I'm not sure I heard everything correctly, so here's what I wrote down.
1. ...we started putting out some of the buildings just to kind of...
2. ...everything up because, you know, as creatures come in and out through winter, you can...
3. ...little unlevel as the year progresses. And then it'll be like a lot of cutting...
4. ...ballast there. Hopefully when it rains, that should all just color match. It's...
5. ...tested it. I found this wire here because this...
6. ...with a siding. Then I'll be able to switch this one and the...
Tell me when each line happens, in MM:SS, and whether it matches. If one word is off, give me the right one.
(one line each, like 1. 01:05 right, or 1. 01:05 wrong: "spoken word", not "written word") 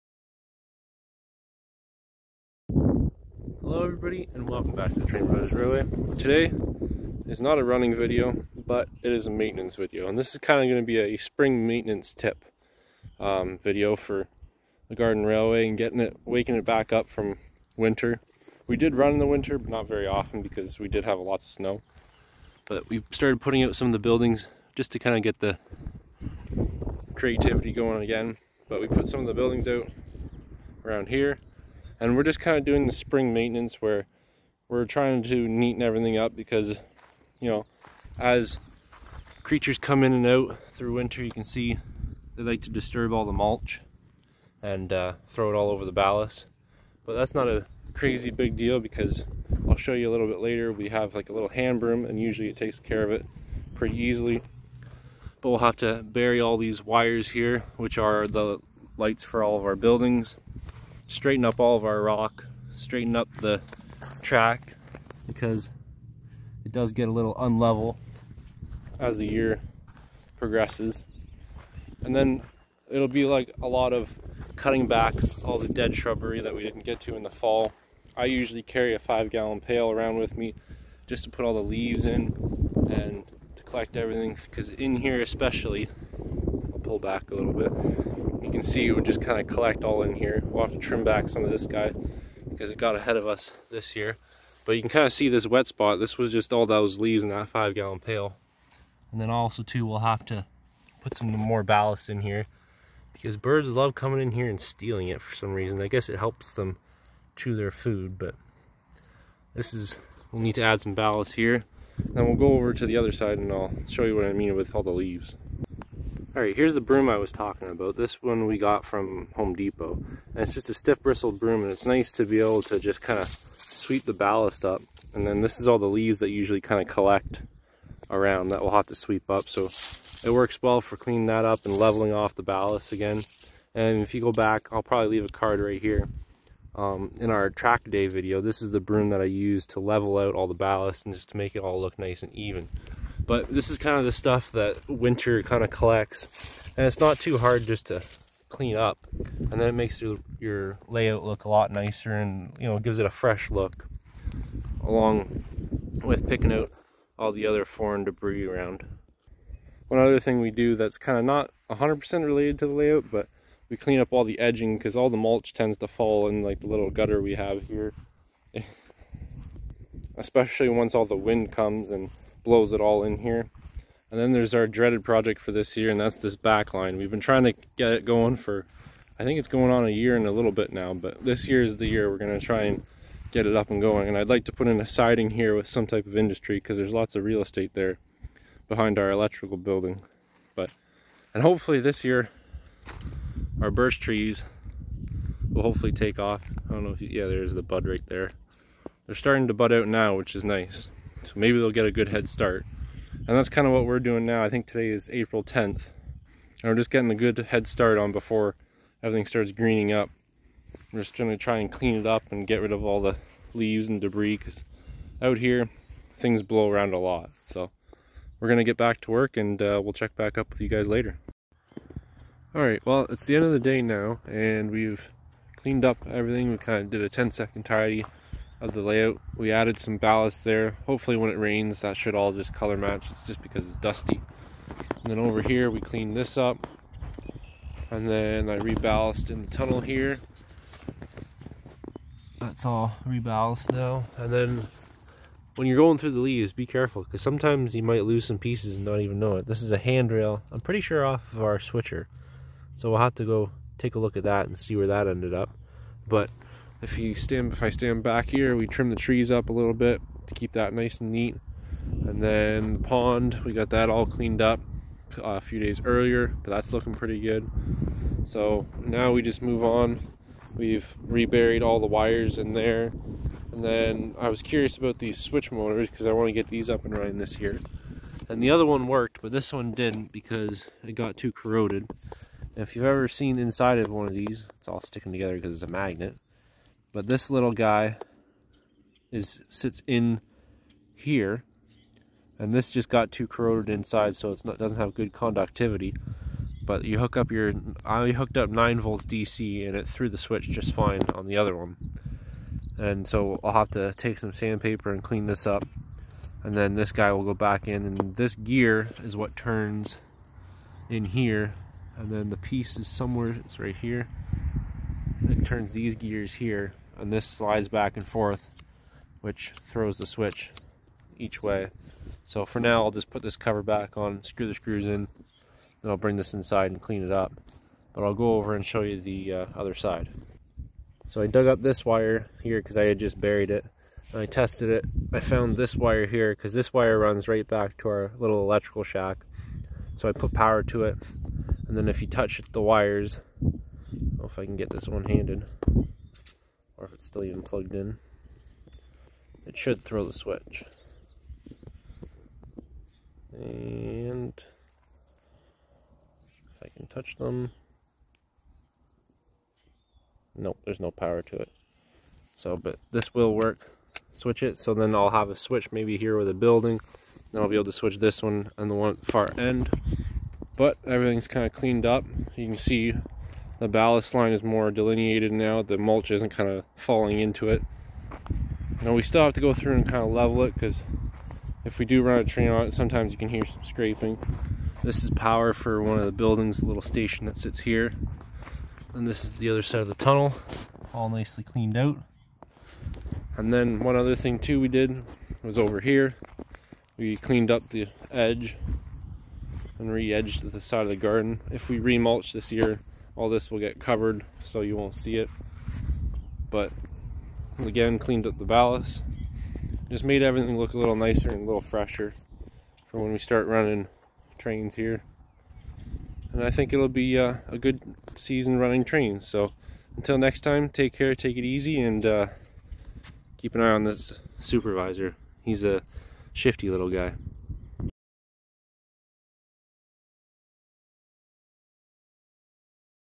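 1. 00:22 right
2. 00:35 right
3. 01:07 right
4. 03:49 right
5. 05:34 right
6. 06:06 wrong: "building", not "siding".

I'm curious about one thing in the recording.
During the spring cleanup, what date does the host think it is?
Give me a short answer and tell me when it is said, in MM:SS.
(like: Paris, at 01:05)
April 10th, at 03:25.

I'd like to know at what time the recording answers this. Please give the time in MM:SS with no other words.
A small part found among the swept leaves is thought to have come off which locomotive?
04:11.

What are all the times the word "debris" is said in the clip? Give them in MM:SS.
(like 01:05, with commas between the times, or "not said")
02:38, 03:34.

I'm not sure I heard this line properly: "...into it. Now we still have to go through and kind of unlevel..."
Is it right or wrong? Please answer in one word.
wrong.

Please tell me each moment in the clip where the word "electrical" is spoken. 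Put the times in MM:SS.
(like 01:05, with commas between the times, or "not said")
03:09, 05:38.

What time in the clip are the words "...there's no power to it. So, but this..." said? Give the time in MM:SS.
06:00.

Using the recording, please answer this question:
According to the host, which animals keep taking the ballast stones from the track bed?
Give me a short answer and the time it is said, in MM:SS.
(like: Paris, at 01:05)
Birds, at 01:43.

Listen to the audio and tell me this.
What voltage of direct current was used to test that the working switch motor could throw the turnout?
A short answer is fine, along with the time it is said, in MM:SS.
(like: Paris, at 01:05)
9 volts, at 04:58.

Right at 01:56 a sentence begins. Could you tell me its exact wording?
Alright, here's the broom I was talking about.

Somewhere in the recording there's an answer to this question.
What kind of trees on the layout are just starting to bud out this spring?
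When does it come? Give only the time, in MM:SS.
03:13.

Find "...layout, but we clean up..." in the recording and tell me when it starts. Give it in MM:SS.
02:42.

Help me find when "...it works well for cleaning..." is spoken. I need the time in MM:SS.
02:10.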